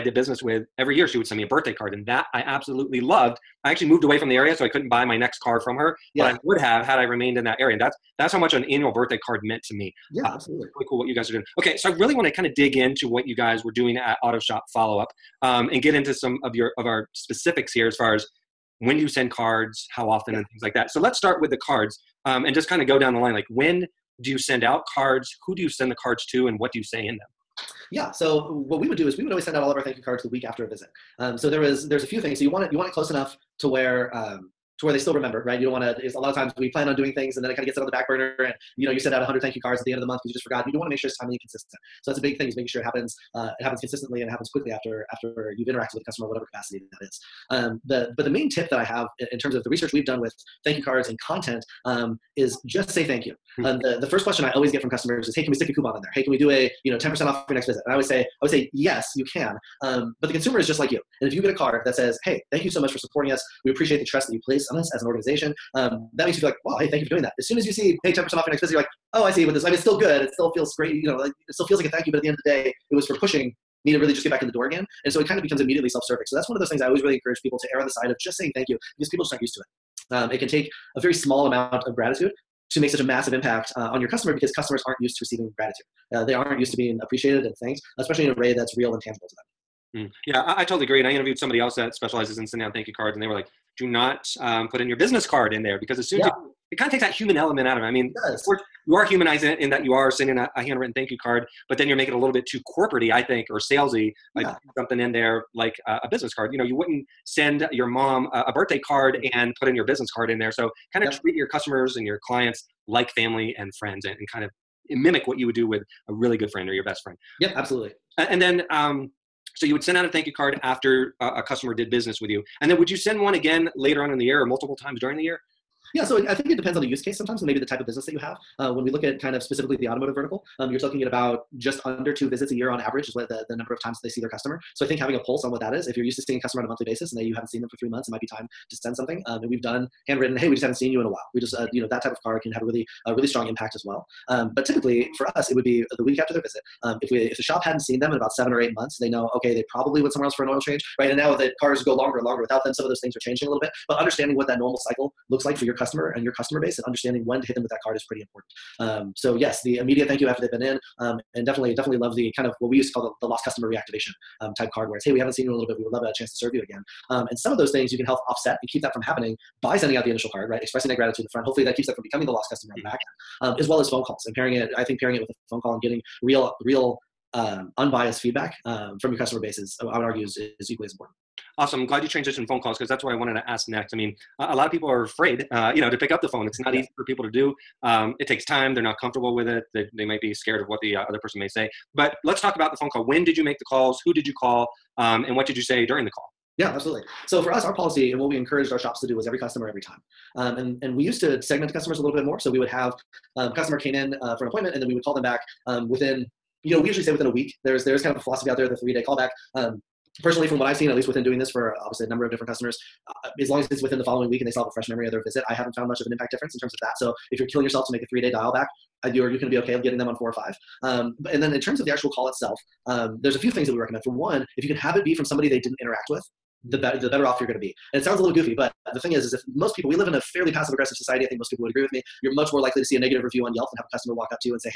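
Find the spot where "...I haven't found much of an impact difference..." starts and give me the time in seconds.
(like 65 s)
215 s.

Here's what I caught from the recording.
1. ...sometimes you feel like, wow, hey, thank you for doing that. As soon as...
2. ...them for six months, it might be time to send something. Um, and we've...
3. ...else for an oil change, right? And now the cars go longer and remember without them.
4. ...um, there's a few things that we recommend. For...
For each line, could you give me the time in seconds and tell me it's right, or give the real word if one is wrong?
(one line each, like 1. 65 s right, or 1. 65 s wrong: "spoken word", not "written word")
1. 66 s wrong: "makes", not "sometimes"
2. 137 s wrong: "three", not "six"
3. 150 s wrong: "longer", not "remember"
4. 222 s right.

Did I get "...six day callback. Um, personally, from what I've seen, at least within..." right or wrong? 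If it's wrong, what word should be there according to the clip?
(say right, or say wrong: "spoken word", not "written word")
wrong: "three", not "six".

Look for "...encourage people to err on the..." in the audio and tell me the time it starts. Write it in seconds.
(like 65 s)
77 s.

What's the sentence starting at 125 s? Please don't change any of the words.
Yeah, so I think it depends on the use case sometimes and maybe the type of business that you have.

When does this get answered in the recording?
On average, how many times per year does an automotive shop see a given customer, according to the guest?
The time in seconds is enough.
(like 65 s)
131 s.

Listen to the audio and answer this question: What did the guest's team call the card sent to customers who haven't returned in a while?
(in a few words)
Lost customer reactivation.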